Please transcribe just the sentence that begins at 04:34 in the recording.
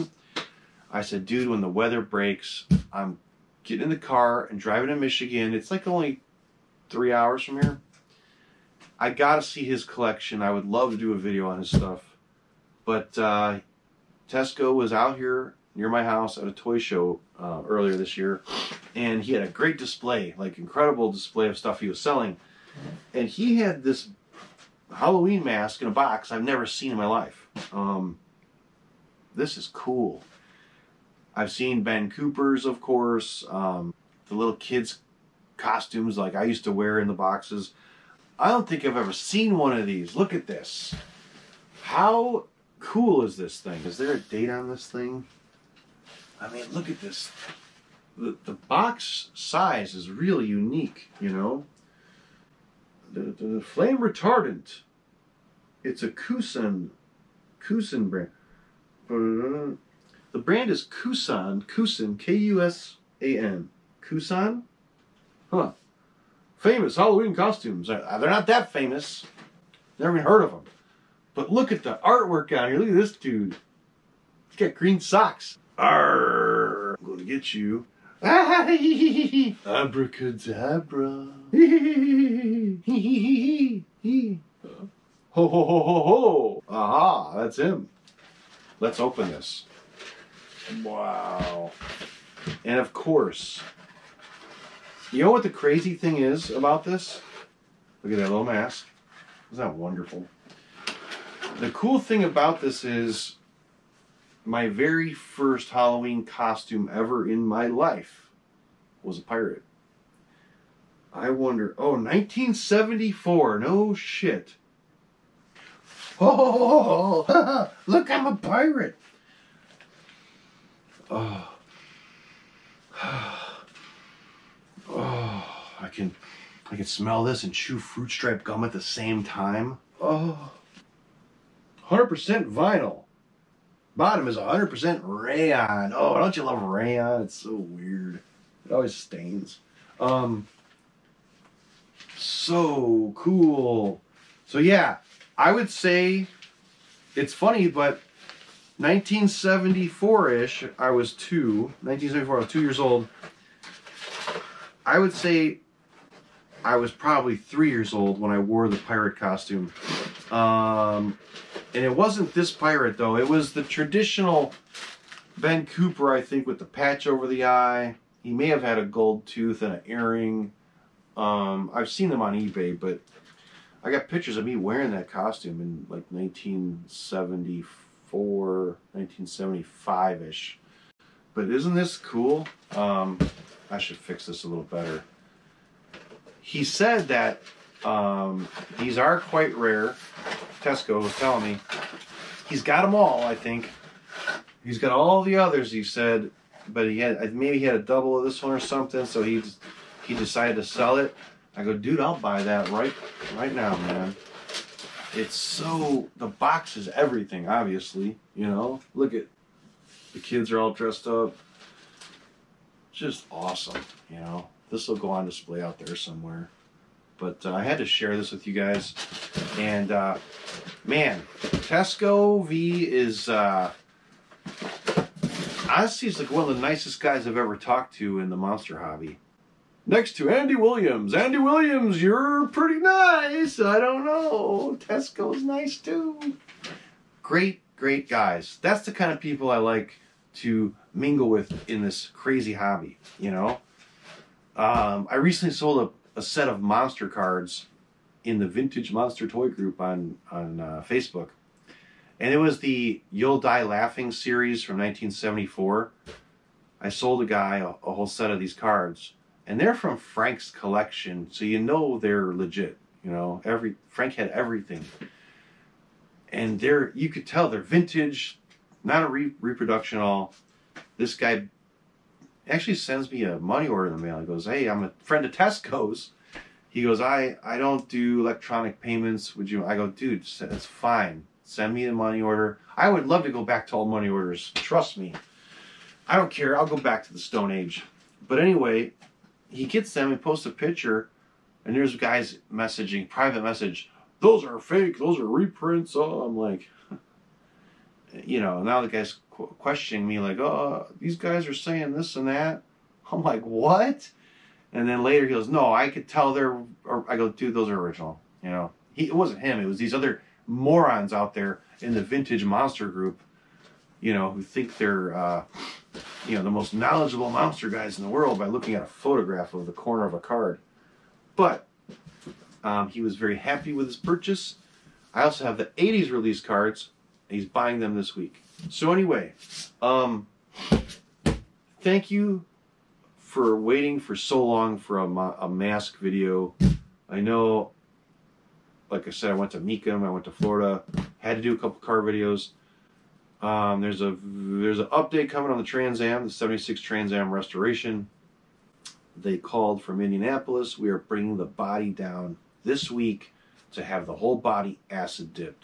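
He goes, "Hey, I'm a friend of Tesco's." He goes, "I I don't do electronic payments.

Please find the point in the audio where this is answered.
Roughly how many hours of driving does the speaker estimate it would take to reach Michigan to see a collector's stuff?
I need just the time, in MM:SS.
00:06.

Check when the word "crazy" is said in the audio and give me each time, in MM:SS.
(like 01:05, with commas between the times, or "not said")
01:35, 04:02.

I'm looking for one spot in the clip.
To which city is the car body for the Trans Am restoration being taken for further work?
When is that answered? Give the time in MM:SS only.
05:49.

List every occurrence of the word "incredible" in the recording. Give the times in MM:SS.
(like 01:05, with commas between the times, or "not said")
00:20.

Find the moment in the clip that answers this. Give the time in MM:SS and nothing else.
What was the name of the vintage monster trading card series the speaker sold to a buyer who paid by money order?
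04:13.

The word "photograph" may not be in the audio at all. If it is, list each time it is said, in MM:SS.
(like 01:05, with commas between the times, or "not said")
05:18.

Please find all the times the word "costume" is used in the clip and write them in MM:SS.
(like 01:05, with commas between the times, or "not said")
00:35, 01:07, 01:46, 02:39, 02:55.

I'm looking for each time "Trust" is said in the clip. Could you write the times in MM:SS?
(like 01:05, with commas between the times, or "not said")
04:44.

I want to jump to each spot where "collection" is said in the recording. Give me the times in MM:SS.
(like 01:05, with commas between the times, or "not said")
00:09, 04:20.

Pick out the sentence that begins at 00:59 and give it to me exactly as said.
The brand is Kusan, Kusan, K-U-S-A-N, Kusan.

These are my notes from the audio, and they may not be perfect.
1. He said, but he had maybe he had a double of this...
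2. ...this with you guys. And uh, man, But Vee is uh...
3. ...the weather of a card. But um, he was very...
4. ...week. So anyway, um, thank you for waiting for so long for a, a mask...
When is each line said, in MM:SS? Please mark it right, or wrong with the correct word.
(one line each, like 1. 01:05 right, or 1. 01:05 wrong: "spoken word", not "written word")
1. 03:15 right
2. 03:38 wrong: "Tesco", not "But"
3. 05:19 wrong: "corner", not "weather"
4. 05:28 right.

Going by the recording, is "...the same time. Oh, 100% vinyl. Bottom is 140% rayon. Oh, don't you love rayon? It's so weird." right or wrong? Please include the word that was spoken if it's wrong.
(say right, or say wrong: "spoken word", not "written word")
wrong: "100", not "140".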